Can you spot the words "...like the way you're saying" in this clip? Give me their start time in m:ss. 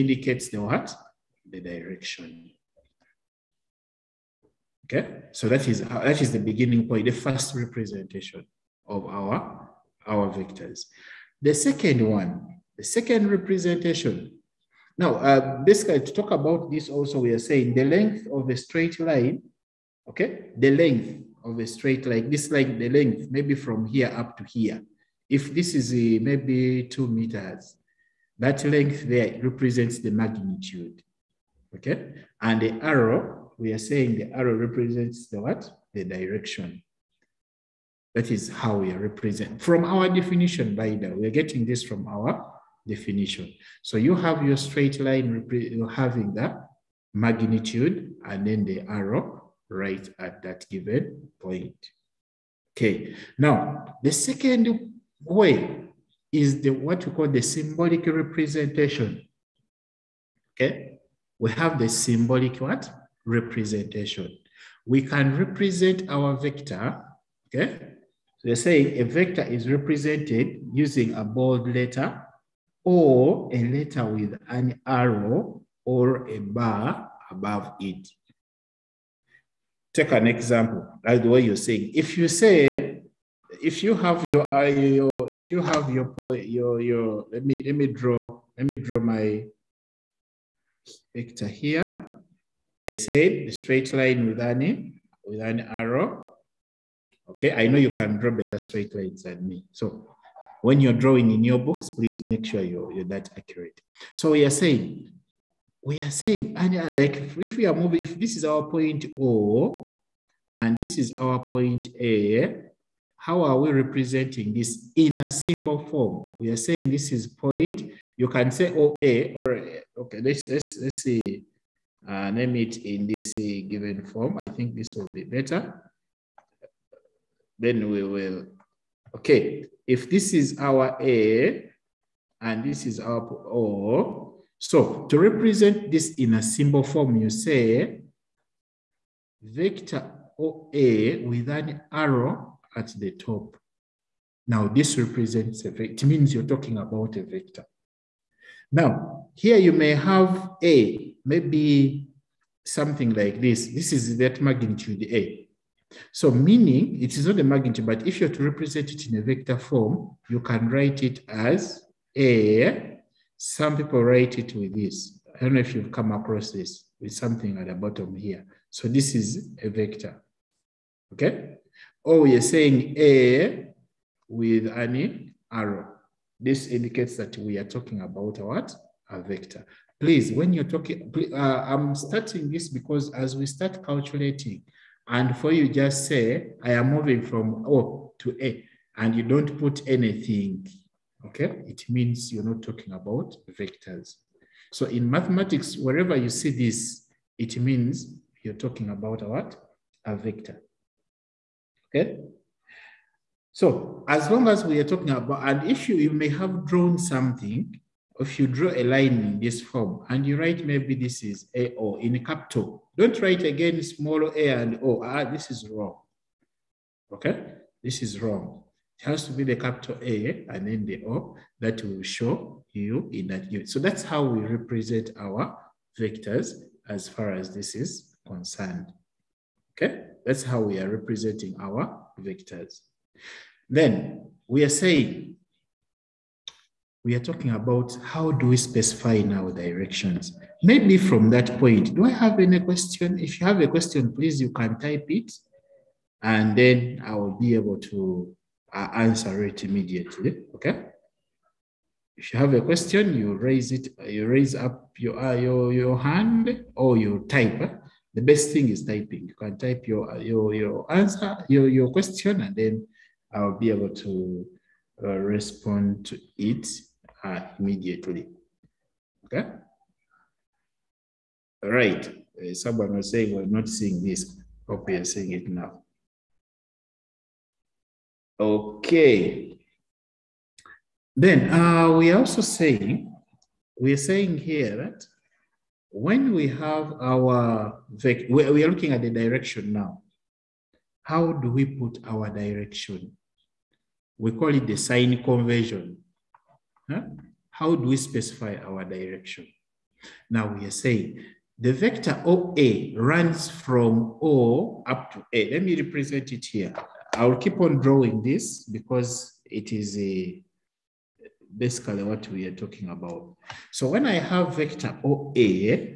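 1:21.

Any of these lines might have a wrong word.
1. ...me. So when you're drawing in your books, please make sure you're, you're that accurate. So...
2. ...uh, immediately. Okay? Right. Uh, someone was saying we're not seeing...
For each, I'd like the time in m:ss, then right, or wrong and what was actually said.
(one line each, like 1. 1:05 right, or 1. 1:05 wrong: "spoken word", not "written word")
1. 1:39 right
2. 4:27 right.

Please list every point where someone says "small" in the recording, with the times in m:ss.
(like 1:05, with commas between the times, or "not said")
3:33.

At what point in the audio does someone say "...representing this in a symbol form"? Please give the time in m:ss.
1:53.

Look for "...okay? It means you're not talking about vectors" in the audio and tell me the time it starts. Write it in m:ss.
3:11.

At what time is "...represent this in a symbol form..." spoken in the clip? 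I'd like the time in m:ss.
2:15.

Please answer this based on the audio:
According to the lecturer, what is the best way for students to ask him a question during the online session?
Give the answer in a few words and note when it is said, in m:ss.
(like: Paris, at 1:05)
typing, at 4:18.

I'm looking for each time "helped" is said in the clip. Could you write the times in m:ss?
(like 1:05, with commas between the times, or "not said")
not said.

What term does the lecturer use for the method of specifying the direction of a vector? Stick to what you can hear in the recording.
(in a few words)
sign convention.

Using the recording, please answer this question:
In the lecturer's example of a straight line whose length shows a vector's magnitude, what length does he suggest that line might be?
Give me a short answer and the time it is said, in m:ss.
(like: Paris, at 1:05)
2 meters, at 0:26.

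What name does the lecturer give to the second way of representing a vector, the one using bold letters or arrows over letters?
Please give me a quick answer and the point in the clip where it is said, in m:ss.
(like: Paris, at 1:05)
symbolic representation, at 0:57.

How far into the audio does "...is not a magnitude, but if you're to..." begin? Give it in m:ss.
2:37.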